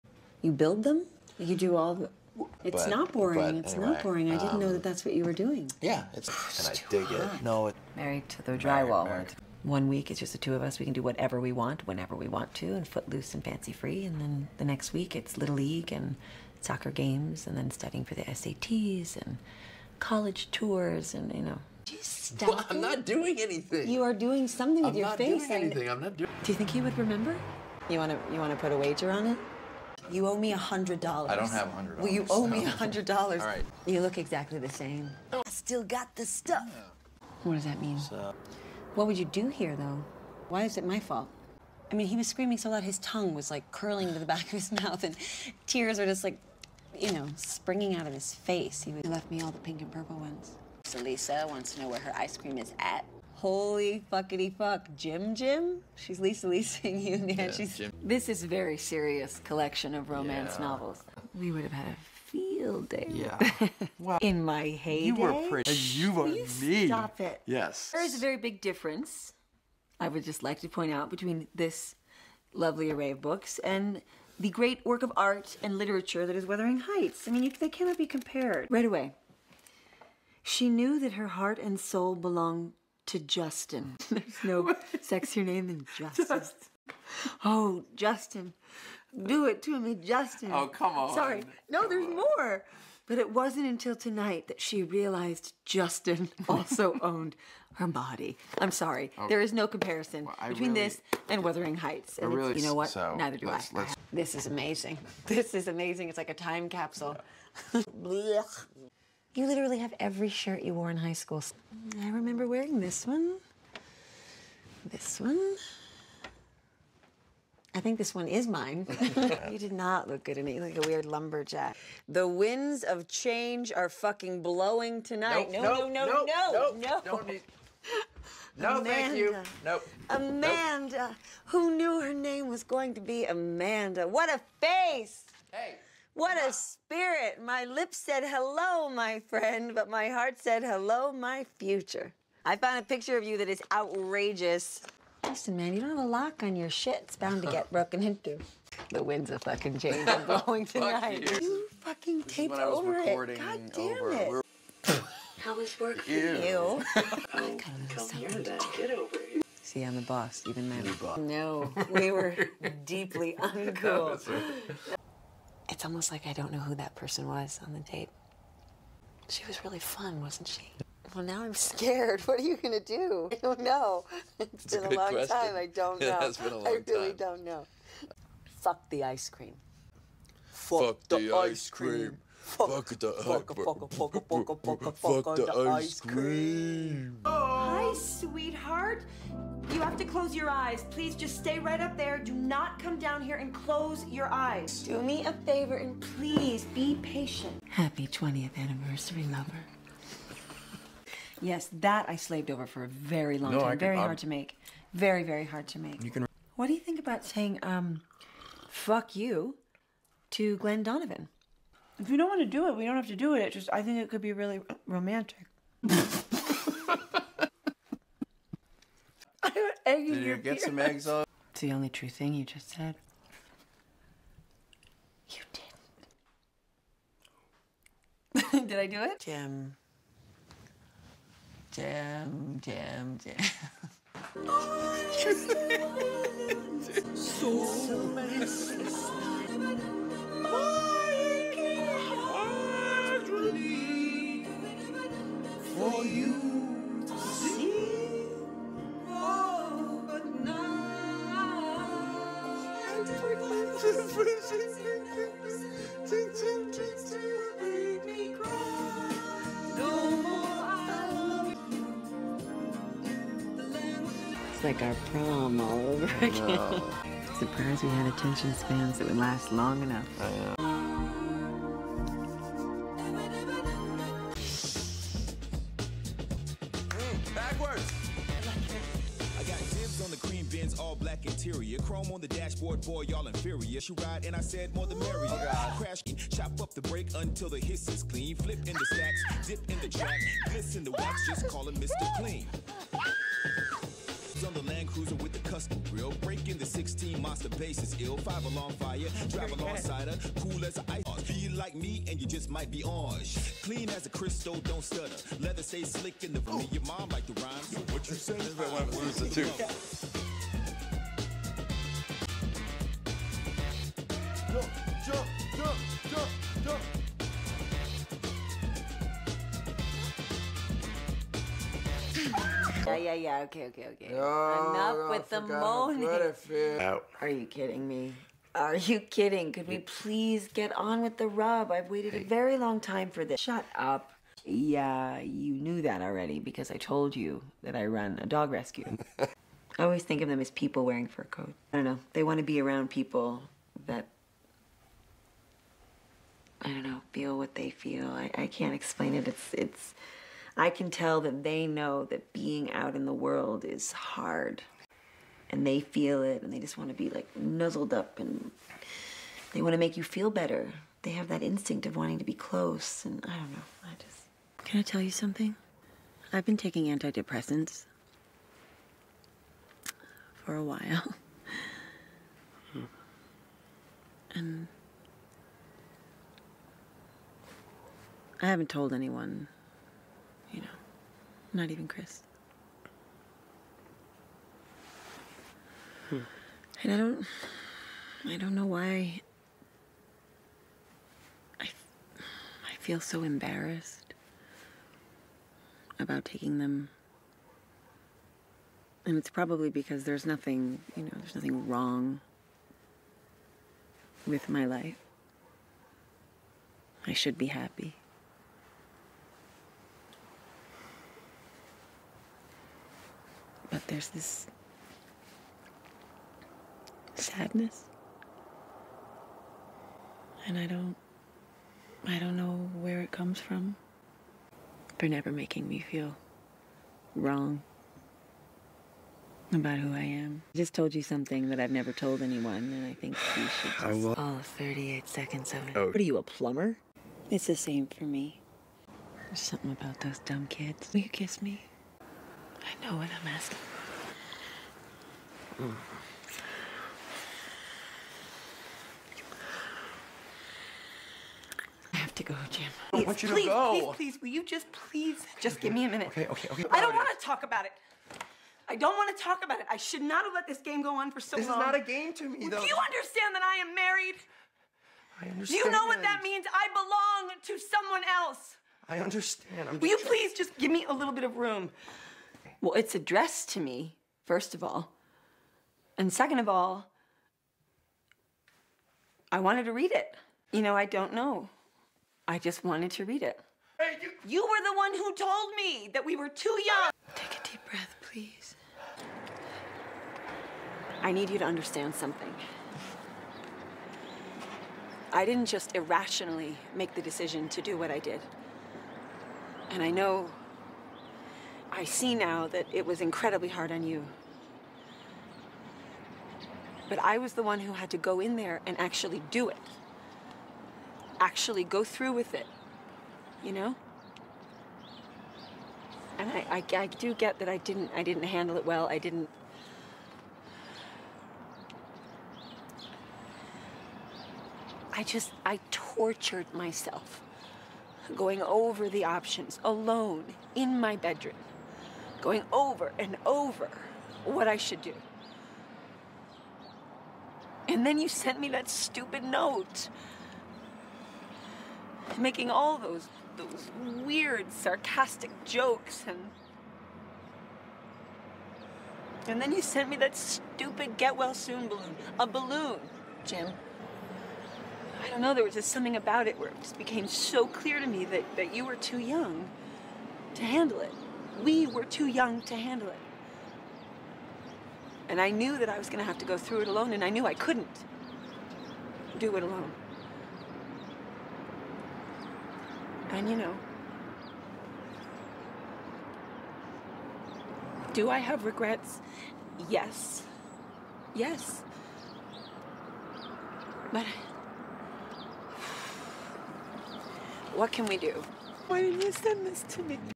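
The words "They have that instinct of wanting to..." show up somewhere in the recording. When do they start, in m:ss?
6:01.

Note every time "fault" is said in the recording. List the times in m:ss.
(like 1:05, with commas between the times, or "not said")
0:40.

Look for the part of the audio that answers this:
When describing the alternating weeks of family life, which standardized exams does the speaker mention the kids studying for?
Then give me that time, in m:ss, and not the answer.
0:18.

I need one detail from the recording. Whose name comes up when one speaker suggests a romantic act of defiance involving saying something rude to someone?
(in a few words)
Glenn Donovan.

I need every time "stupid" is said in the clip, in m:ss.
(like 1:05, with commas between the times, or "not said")
8:58, 9:10.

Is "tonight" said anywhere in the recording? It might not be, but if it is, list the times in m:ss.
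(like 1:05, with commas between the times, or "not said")
1:33, 2:05, 2:30.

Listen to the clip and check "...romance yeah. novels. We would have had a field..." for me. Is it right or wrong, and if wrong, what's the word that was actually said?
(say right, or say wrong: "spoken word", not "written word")
right.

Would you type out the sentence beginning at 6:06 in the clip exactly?
I've been taking antidepressants for a while.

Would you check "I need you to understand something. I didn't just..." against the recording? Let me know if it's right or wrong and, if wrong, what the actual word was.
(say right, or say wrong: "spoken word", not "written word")
right.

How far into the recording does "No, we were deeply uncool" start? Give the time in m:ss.
2:41.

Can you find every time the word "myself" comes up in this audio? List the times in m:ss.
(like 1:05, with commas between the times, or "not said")
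8:46.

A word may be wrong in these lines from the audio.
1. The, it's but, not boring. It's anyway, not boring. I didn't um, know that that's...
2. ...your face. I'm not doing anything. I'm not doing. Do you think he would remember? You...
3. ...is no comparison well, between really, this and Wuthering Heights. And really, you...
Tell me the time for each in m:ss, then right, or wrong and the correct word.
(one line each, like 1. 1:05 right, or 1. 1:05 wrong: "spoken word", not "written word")
1. 0:01 right
2. 0:24 right
3. 1:39 right.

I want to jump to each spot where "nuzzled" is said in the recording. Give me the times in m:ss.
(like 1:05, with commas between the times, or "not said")
5:57.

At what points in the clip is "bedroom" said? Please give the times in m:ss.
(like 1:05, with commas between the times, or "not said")
8:50.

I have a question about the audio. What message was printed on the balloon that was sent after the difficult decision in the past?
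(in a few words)
Get well soon.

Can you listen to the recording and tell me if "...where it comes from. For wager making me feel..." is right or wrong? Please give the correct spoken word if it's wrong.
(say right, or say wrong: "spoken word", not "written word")
wrong: "never", not "wager".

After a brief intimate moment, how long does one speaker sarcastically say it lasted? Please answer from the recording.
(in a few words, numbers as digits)
38 seconds.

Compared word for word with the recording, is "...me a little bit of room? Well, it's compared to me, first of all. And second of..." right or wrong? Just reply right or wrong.
wrong.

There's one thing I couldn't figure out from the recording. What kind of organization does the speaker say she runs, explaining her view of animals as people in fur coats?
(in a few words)
A dog rescue.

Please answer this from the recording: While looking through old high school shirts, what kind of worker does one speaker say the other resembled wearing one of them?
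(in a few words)
A weird lumberjack.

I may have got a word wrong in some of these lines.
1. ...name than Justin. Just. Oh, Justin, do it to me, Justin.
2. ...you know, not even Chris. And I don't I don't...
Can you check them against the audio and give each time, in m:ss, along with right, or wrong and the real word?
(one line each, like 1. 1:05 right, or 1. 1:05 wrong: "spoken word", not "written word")
1. 1:25 right
2. 6:20 right.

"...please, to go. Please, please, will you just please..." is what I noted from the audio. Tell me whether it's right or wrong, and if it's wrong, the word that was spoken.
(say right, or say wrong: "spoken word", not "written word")
right.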